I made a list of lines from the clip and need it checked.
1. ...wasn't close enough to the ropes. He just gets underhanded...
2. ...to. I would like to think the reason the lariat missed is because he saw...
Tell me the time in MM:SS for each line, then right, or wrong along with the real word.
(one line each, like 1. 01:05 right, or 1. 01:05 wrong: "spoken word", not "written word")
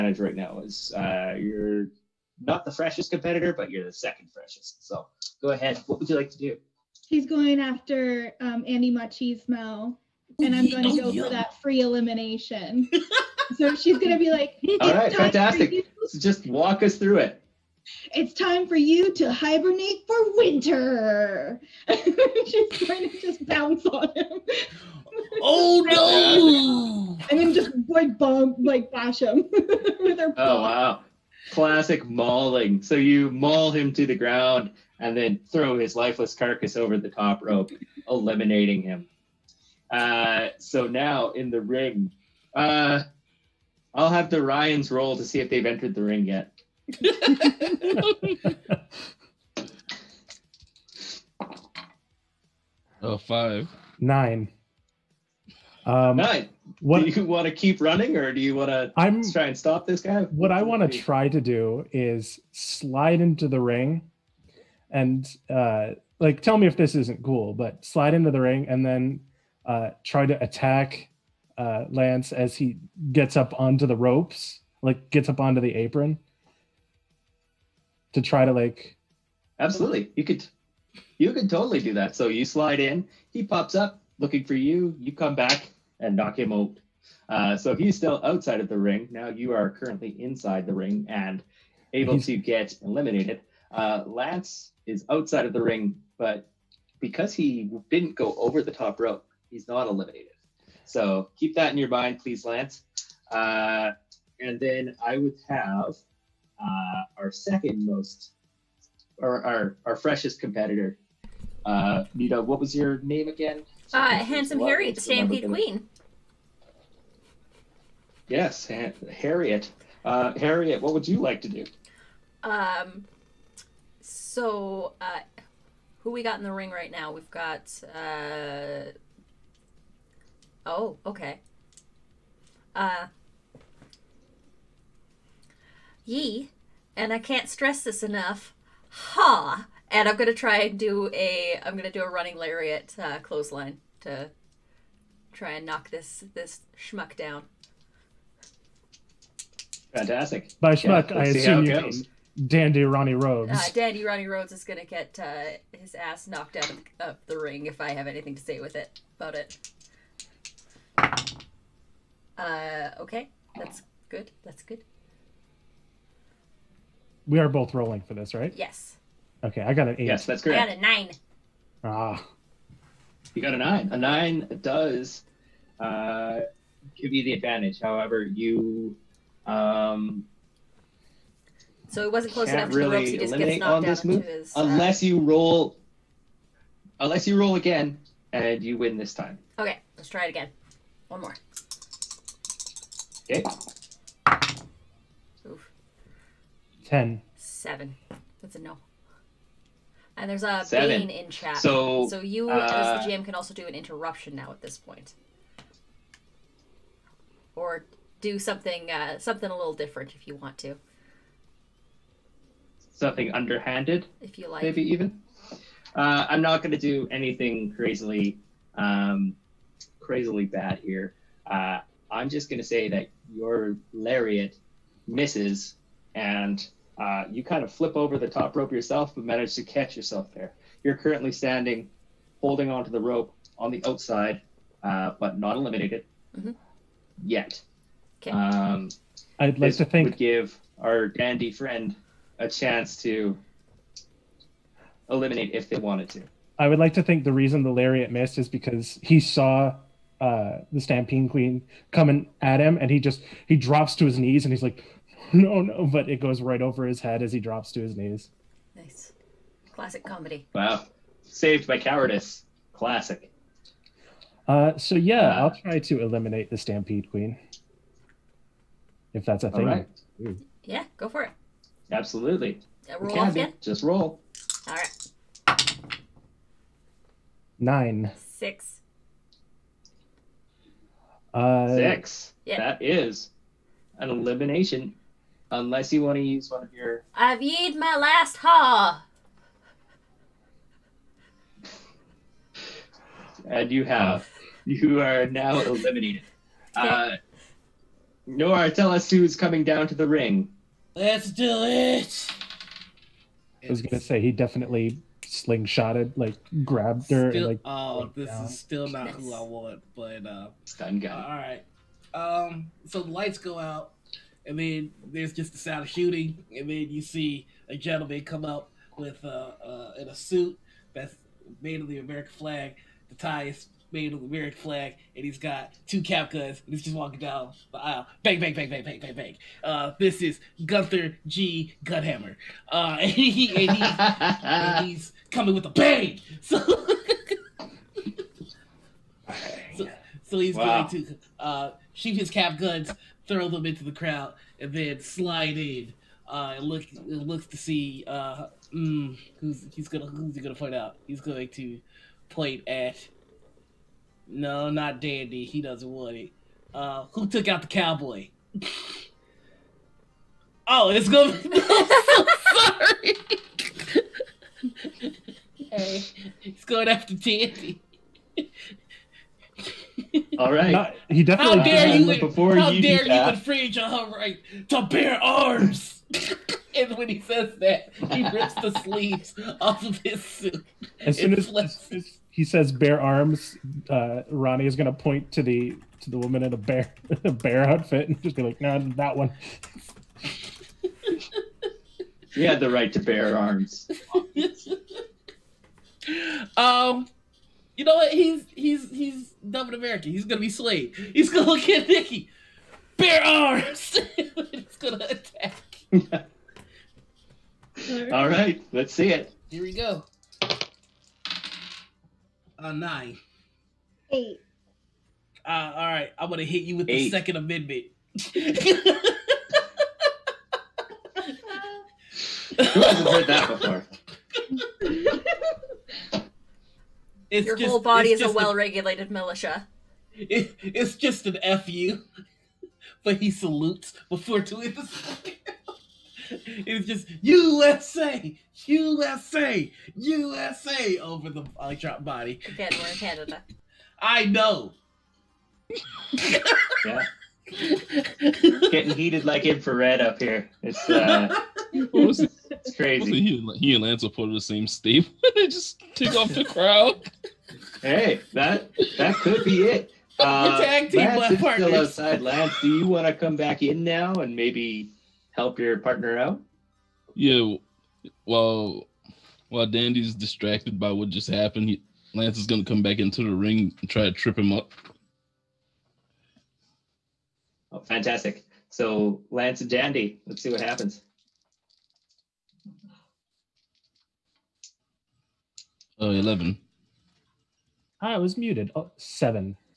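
1. 03:02 wrong: "knocked", not "underhanded"
2. 04:06 right.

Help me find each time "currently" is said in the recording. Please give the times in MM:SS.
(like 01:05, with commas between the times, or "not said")
01:29, 03:50.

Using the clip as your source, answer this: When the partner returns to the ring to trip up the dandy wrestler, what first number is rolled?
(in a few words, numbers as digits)
11.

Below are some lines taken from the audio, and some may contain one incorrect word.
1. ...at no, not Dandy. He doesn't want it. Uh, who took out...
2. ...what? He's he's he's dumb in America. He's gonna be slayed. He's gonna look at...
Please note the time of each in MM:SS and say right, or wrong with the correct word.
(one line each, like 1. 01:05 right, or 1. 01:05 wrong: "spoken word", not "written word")
1. 05:52 right
2. 06:37 right.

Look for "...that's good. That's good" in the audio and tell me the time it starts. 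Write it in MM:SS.
02:43.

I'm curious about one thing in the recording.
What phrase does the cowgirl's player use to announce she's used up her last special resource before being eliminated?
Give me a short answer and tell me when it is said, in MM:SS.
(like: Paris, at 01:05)
I've yeed my last haw, at 04:47.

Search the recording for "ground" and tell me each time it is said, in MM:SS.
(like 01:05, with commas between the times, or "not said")
00:34.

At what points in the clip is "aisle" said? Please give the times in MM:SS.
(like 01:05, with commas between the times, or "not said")
05:27.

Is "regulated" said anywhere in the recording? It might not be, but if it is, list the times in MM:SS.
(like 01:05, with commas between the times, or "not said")
07:08.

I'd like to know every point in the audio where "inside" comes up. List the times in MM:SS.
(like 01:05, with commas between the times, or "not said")
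01:30.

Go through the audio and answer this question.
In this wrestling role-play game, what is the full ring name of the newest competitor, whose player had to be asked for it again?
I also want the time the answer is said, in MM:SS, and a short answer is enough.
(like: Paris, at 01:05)
Handsome Harriet, the Stampede Queen, at 01:54.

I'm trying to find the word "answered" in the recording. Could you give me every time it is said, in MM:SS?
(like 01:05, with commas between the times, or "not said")
not said.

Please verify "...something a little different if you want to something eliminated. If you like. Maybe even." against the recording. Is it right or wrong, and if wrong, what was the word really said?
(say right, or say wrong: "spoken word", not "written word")
wrong: "underhanded", not "eliminated".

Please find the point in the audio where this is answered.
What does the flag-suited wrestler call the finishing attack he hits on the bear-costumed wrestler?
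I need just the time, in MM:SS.
06:57.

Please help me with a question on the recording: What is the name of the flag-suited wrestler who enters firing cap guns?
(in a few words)
Gunther G. Gunhammer.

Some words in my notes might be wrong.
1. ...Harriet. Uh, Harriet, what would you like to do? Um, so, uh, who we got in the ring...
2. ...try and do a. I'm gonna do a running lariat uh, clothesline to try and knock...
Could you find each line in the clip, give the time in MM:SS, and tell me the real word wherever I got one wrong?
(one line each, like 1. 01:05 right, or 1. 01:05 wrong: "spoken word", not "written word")
1. 01:59 right
2. 02:20 right.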